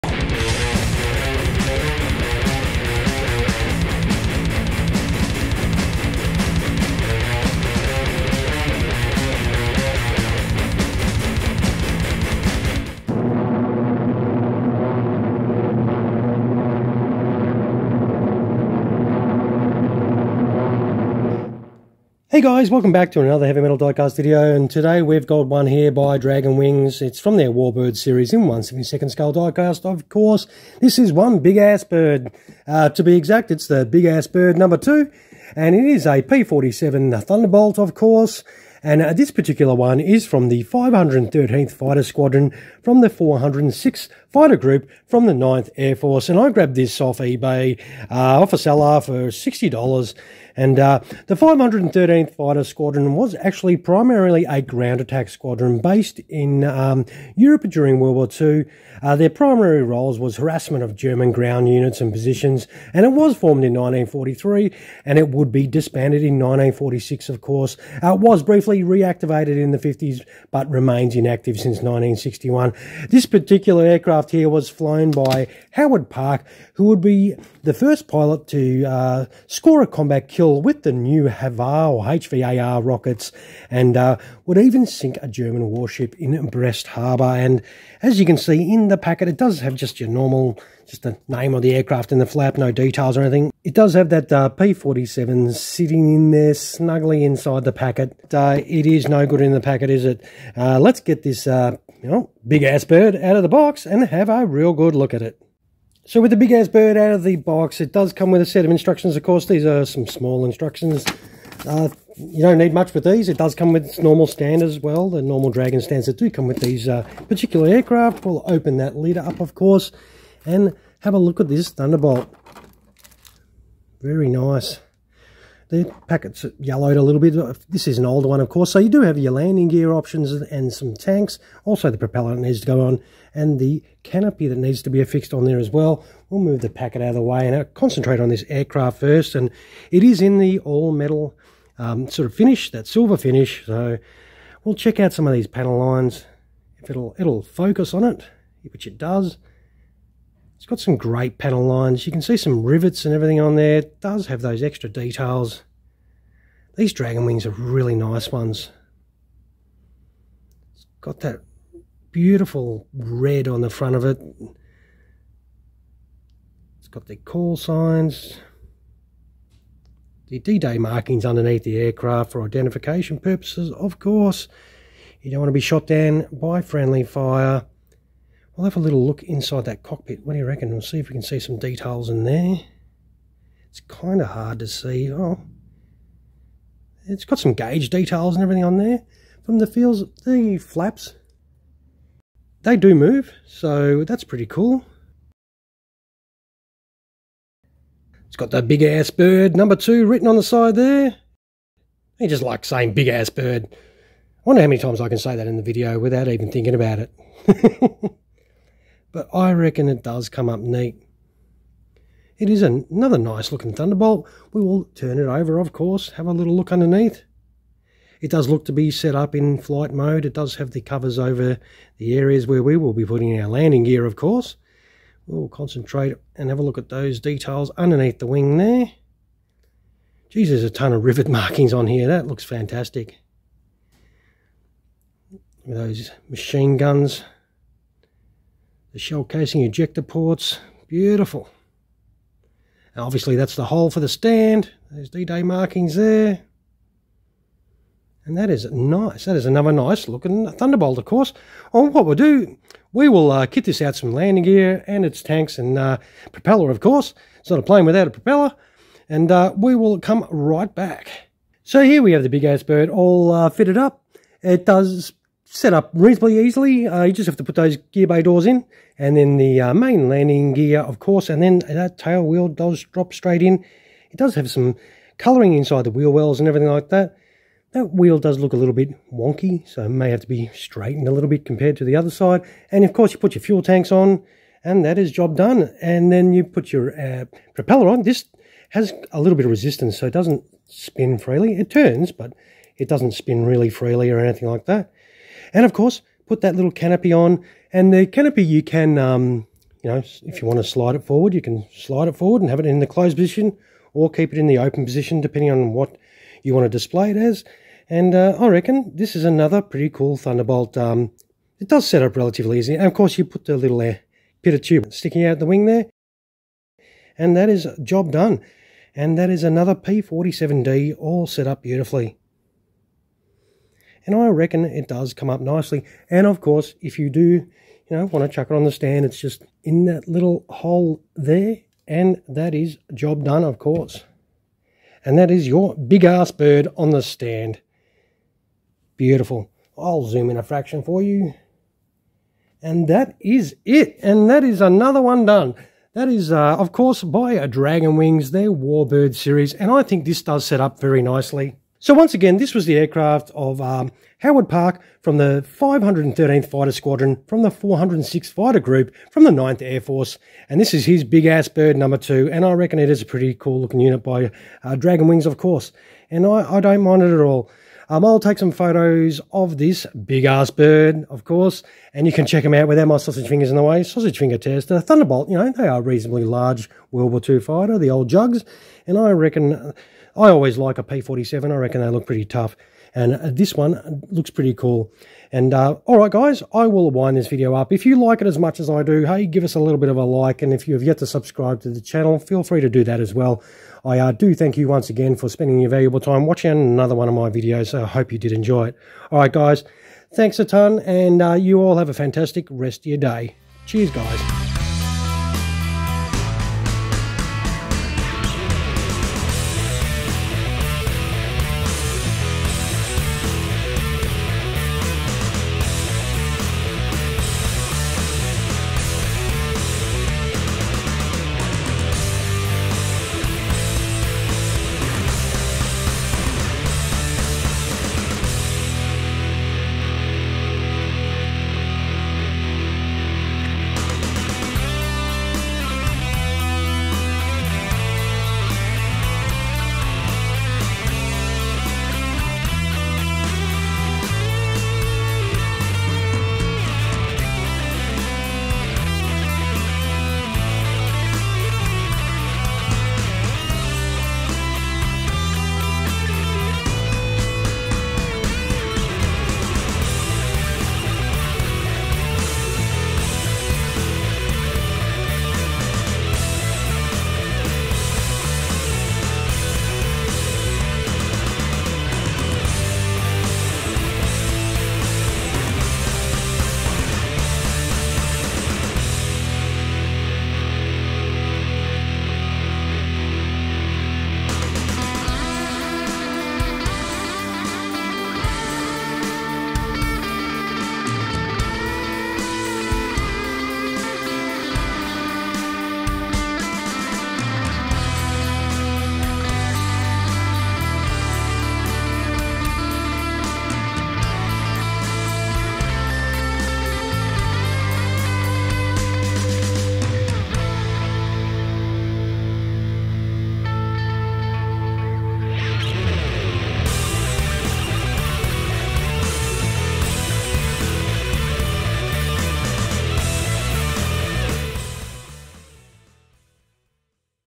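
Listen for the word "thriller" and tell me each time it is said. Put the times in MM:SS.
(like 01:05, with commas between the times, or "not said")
not said.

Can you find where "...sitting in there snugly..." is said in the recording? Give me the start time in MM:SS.
01:35.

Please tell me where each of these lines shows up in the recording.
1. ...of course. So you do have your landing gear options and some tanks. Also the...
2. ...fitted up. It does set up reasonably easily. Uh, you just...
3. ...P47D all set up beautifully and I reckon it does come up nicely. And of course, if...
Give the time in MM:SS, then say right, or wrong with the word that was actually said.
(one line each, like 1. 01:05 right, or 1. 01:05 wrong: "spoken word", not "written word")
1. 02:08 right
2. 04:23 right
3. 05:19 right.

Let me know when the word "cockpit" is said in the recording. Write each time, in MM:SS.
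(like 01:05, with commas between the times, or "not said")
02:59.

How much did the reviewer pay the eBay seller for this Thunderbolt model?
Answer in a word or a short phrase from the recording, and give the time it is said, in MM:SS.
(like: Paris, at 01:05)
$60, at 00:49.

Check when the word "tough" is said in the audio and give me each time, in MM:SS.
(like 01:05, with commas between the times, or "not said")
06:22.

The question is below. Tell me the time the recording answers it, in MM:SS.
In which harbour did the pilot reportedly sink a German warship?
01:26.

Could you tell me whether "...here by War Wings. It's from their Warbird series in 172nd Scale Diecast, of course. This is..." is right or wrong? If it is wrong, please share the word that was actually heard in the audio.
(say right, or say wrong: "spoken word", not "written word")
wrong: "Dragon", not "War".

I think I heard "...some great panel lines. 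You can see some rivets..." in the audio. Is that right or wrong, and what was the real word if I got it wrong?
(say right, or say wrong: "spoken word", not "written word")
right.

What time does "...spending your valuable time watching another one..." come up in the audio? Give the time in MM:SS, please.
06:35.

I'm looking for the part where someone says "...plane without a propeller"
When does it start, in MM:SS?
04:17.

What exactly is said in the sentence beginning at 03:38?
It does look to be set up in flight mode.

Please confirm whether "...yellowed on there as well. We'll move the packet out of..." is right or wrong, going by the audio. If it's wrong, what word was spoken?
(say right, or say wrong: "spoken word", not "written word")
wrong: "affixed", not "yellowed".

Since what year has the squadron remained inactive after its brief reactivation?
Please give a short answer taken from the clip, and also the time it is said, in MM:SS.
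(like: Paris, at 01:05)
1961, at 01:11.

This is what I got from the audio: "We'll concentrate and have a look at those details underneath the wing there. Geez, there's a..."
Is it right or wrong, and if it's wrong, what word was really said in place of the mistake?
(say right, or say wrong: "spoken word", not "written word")
right.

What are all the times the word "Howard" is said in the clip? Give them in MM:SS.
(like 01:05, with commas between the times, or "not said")
01:15, 05:54.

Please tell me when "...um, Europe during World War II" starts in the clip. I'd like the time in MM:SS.
00:56.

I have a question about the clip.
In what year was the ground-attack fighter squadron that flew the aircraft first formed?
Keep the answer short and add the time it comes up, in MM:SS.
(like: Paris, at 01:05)
1943, at 01:03.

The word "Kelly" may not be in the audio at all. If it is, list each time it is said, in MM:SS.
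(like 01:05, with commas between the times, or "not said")
not said.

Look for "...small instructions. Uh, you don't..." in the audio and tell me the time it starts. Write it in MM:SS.
01:50.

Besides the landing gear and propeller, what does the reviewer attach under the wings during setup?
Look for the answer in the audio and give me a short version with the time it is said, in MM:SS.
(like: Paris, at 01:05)
Fuel tanks, at 04:43.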